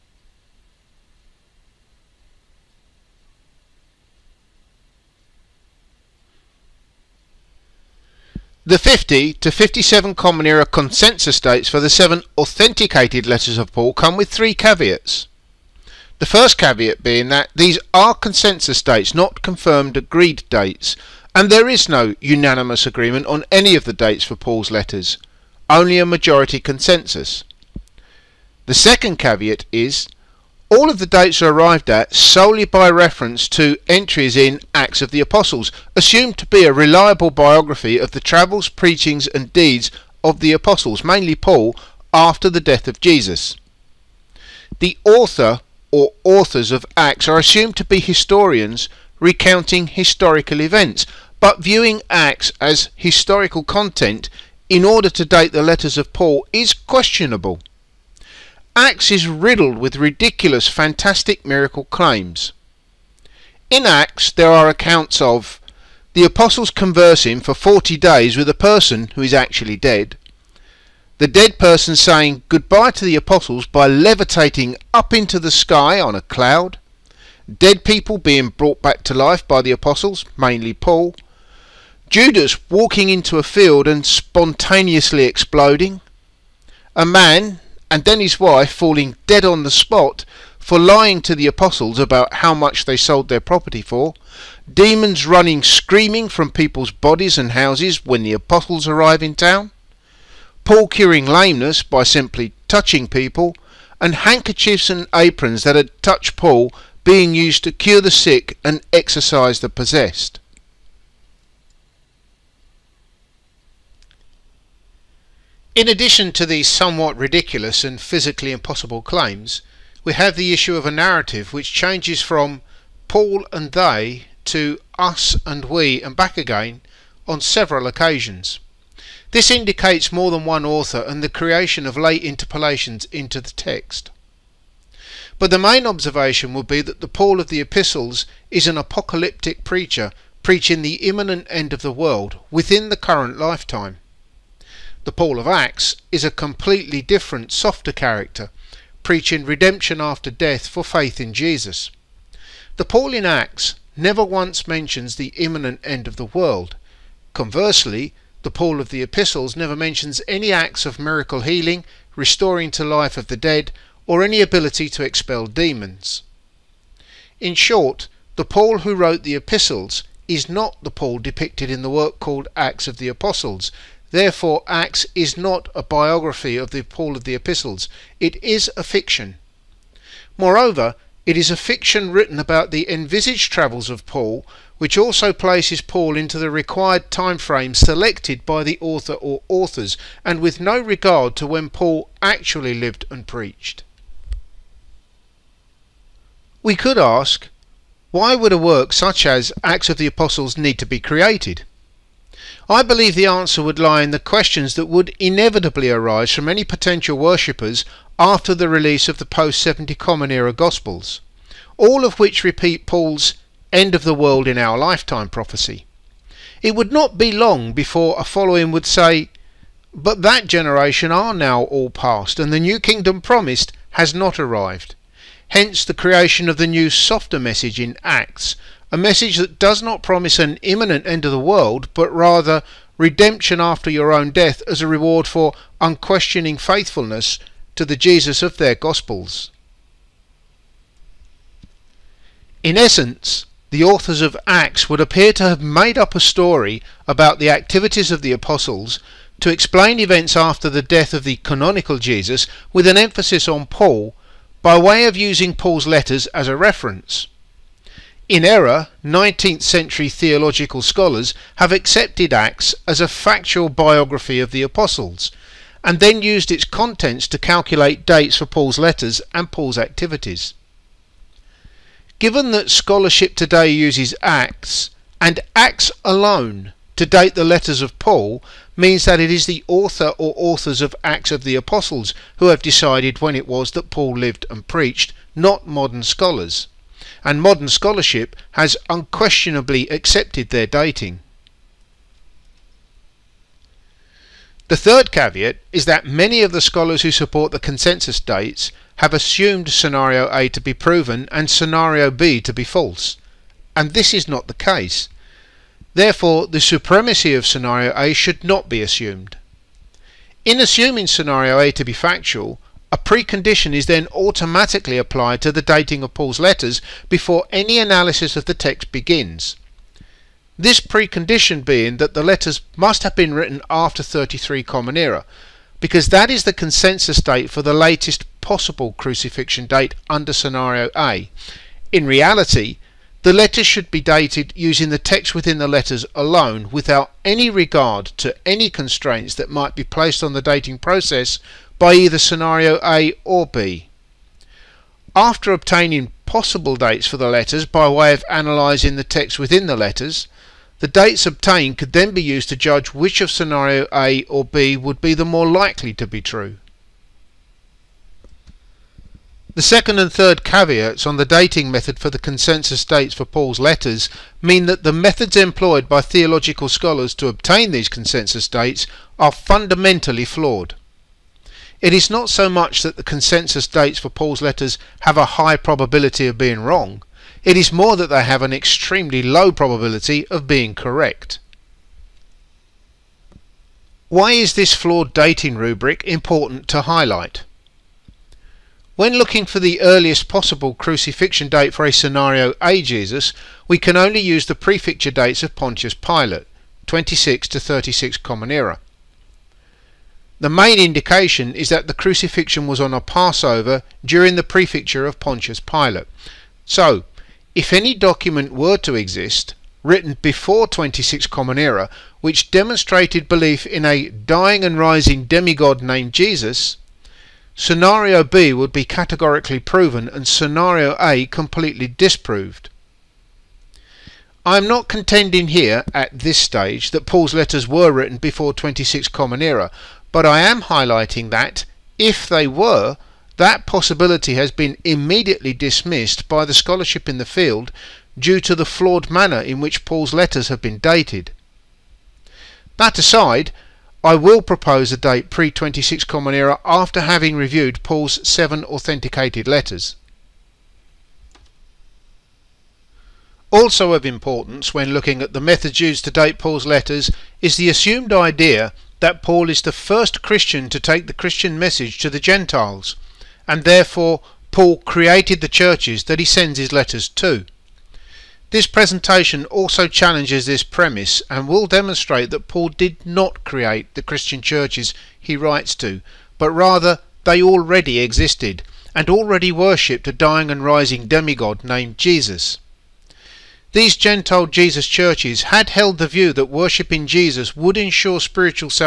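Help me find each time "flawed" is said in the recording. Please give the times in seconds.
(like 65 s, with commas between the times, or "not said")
370 s, 384 s, 438 s.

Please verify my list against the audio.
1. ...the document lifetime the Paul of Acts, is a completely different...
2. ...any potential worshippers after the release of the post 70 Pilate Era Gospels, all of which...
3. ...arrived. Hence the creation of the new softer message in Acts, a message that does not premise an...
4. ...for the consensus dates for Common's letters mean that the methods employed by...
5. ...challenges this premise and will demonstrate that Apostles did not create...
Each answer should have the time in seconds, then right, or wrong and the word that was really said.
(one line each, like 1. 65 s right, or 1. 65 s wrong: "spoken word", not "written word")
1. 142 s wrong: "current", not "document"
2. 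206 s wrong: "Common", not "Pilate"
3. 224 s wrong: "promise", not "premise"
4. 361 s wrong: "Paul", not "Common"
5. 469 s wrong: "Paul", not "Apostles".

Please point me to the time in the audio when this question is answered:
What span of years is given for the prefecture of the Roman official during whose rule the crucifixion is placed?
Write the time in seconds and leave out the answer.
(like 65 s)
396 s.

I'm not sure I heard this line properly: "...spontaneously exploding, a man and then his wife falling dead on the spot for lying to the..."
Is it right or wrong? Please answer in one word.
right.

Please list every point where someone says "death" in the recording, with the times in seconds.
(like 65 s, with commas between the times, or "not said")
42 s, 150 s, 234 s, 250 s.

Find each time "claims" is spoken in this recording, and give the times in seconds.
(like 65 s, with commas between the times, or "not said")
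61 s, 119 s.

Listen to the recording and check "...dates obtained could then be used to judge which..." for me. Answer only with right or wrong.
right.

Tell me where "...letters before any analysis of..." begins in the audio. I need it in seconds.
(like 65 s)
316 s.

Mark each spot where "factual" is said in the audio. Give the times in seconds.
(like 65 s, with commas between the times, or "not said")
263 s, 311 s.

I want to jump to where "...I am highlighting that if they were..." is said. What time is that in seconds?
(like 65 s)
430 s.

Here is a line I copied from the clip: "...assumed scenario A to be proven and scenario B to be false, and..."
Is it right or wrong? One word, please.
right.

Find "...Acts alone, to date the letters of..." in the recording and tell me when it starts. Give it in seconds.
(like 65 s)
275 s.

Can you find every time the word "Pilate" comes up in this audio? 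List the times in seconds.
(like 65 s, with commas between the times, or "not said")
395 s, 405 s.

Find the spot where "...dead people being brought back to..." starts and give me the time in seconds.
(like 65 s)
77 s.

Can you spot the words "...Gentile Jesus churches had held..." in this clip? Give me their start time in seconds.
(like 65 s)
483 s.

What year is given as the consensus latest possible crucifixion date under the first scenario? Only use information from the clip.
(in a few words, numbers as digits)
33 CE.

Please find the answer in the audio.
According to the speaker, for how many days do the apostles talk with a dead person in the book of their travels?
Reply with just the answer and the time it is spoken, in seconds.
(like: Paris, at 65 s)
40, at 67 s.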